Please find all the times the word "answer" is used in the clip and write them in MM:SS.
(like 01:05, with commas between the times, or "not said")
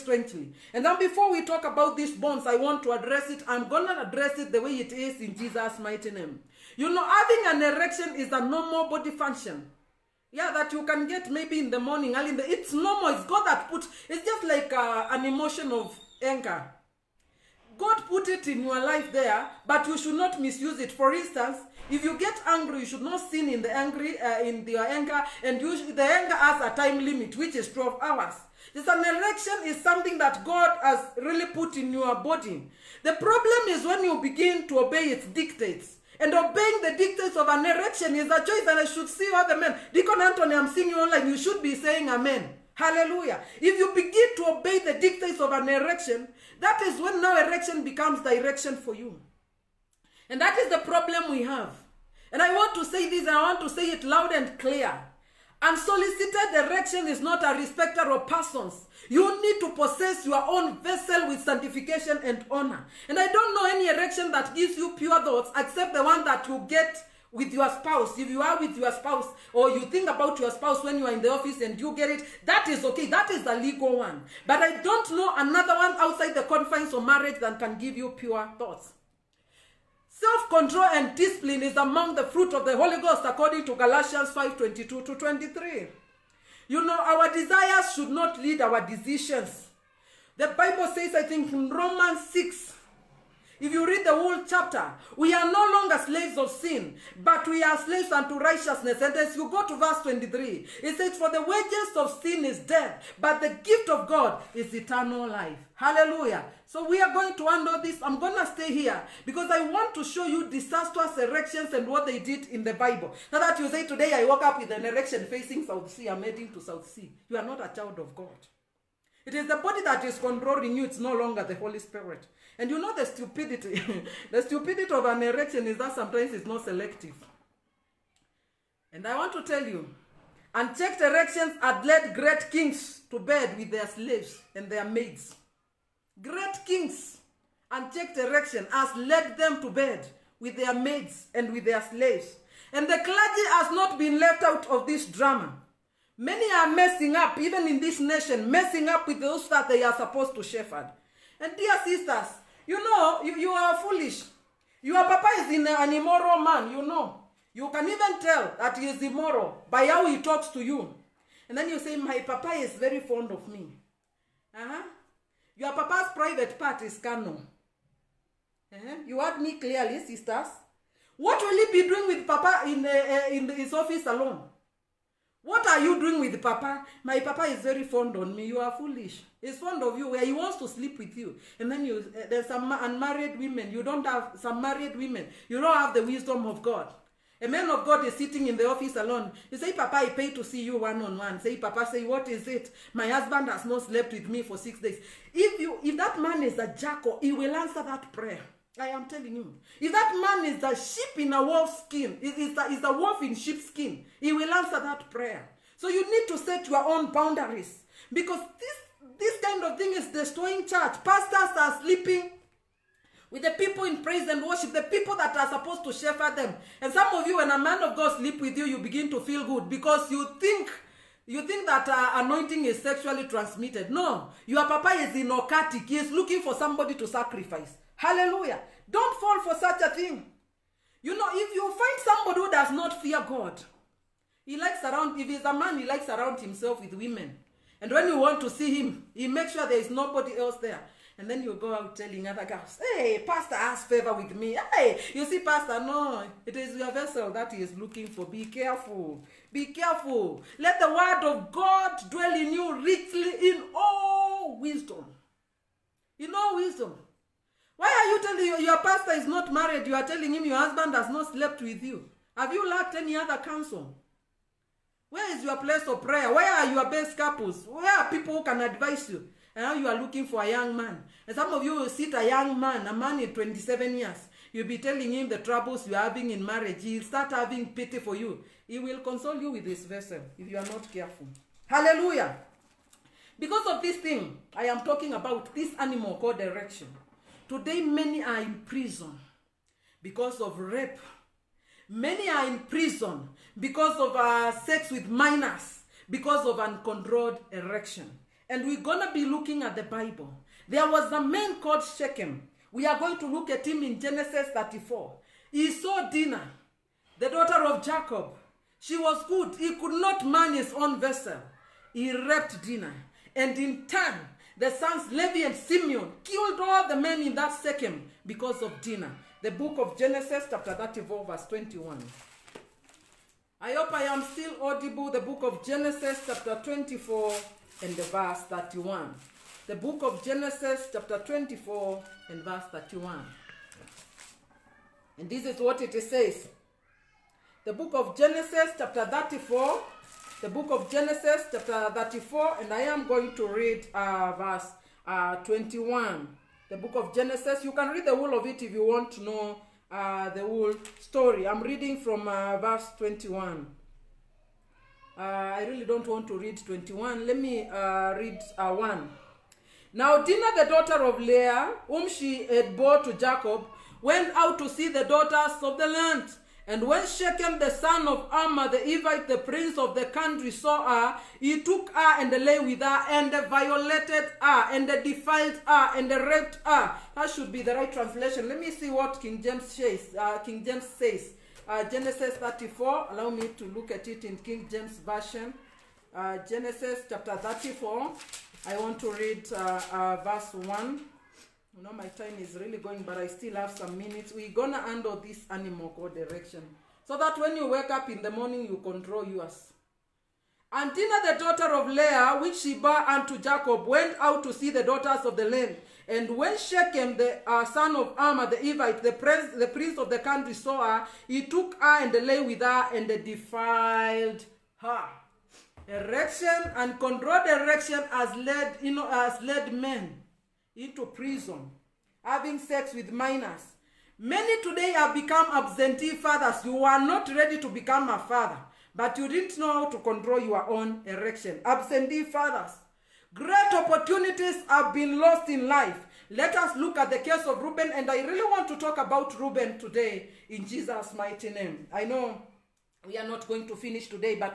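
03:17, 03:24.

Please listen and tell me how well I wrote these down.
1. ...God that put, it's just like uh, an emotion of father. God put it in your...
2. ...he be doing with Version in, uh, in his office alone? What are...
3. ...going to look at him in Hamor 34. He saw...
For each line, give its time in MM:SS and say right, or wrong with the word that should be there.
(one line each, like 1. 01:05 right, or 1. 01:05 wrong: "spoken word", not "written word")
1. 00:13 wrong: "anger", not "father"
2. 02:51 wrong: "Papa", not "Version"
3. 05:02 wrong: "Genesis", not "Hamor".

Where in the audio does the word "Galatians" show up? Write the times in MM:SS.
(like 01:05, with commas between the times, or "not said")
01:23.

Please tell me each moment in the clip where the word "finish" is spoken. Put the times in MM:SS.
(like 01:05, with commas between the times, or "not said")
07:23.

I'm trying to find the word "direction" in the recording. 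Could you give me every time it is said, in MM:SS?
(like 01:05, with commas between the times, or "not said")
00:48, 02:18, 04:46, 06:36.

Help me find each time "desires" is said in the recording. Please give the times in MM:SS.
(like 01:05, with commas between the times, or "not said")
01:27.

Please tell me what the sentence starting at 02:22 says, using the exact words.
And the clergy has not been left out of this drama.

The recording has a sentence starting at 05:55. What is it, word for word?
Uh, I really don't want to read 21.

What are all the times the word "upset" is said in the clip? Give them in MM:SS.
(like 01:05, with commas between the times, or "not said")
not said.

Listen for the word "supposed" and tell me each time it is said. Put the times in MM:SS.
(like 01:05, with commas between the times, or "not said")
02:29, 03:35.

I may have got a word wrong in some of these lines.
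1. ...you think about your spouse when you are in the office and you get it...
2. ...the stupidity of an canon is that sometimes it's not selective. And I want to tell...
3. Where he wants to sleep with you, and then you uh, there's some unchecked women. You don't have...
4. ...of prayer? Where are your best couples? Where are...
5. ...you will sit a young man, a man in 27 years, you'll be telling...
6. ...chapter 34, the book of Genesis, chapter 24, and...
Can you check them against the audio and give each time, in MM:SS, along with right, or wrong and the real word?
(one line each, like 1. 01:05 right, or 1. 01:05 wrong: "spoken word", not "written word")
1. 01:09 right
2. 02:04 wrong: "erection", not "canon"
3. 03:00 wrong: "unmarried", not "unchecked"
4. 04:25 right
5. 04:31 right
6. 05:38 wrong: "34", not "24".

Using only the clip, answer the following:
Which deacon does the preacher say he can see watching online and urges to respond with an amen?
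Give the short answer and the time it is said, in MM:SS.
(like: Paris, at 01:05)
Deacon Anthony, at 00:39.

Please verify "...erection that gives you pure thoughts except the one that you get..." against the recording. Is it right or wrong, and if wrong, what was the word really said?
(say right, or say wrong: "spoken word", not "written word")
right.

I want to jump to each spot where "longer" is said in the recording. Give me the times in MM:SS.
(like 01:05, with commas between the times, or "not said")
01:35, 02:01.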